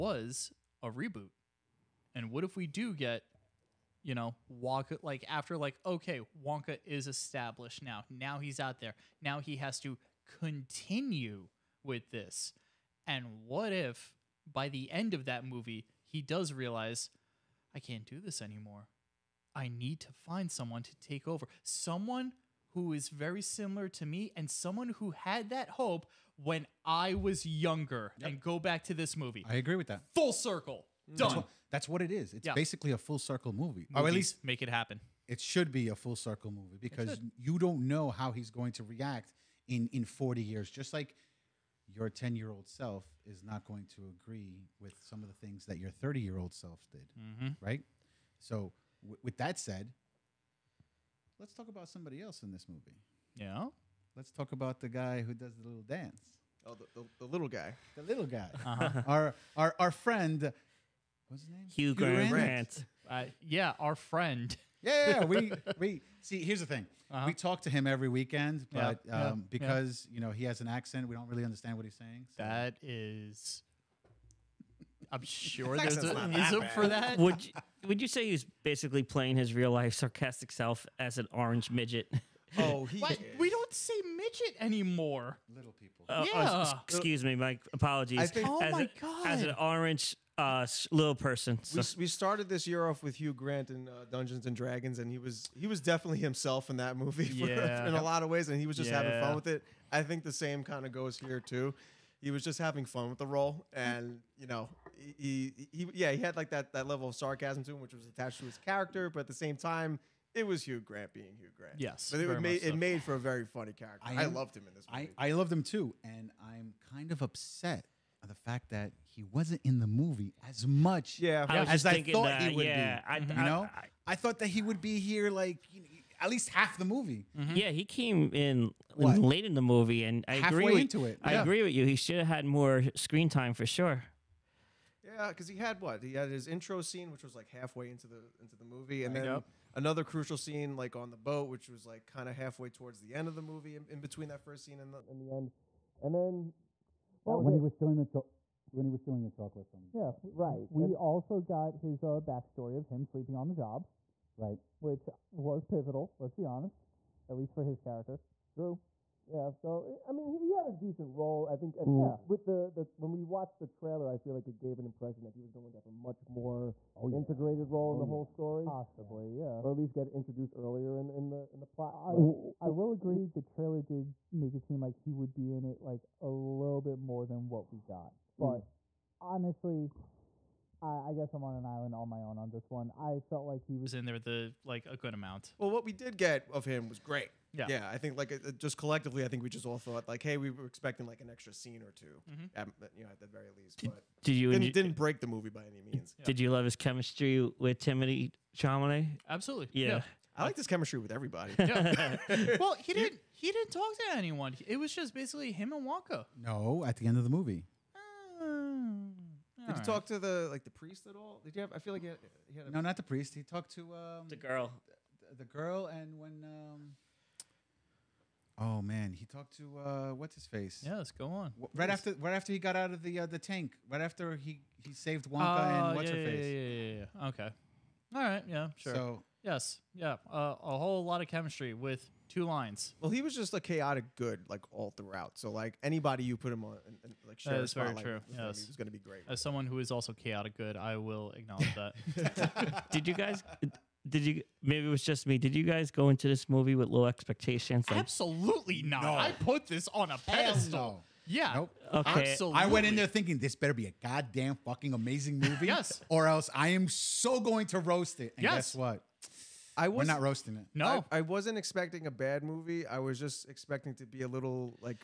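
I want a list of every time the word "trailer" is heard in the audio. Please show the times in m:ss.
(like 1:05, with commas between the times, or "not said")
2:43, 2:53.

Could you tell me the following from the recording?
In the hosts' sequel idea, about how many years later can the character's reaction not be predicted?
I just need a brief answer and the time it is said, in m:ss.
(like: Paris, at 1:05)
40, at 0:40.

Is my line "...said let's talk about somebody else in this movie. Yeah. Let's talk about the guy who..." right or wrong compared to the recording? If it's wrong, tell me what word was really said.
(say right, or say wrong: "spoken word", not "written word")
right.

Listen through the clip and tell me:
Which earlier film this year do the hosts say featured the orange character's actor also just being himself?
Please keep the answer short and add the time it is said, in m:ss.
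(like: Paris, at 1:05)
Dungeons and Dragons, at 1:34.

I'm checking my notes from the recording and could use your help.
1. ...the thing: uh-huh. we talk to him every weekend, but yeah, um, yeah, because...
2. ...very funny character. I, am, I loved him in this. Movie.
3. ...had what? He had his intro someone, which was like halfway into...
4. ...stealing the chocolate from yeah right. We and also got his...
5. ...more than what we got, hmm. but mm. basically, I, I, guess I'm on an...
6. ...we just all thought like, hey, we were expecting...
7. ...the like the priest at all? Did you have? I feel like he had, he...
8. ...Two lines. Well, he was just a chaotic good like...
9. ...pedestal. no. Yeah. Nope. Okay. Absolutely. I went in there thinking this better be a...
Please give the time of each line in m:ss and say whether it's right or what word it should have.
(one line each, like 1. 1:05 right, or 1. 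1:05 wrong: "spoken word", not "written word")
1. 1:06 right
2. 1:53 right
3. 2:15 wrong: "scene", not "someone"
4. 2:29 right
5. 2:57 wrong: "honestly", not "basically"
6. 3:09 right
7. 3:30 right
8. 3:52 right
9. 4:10 right.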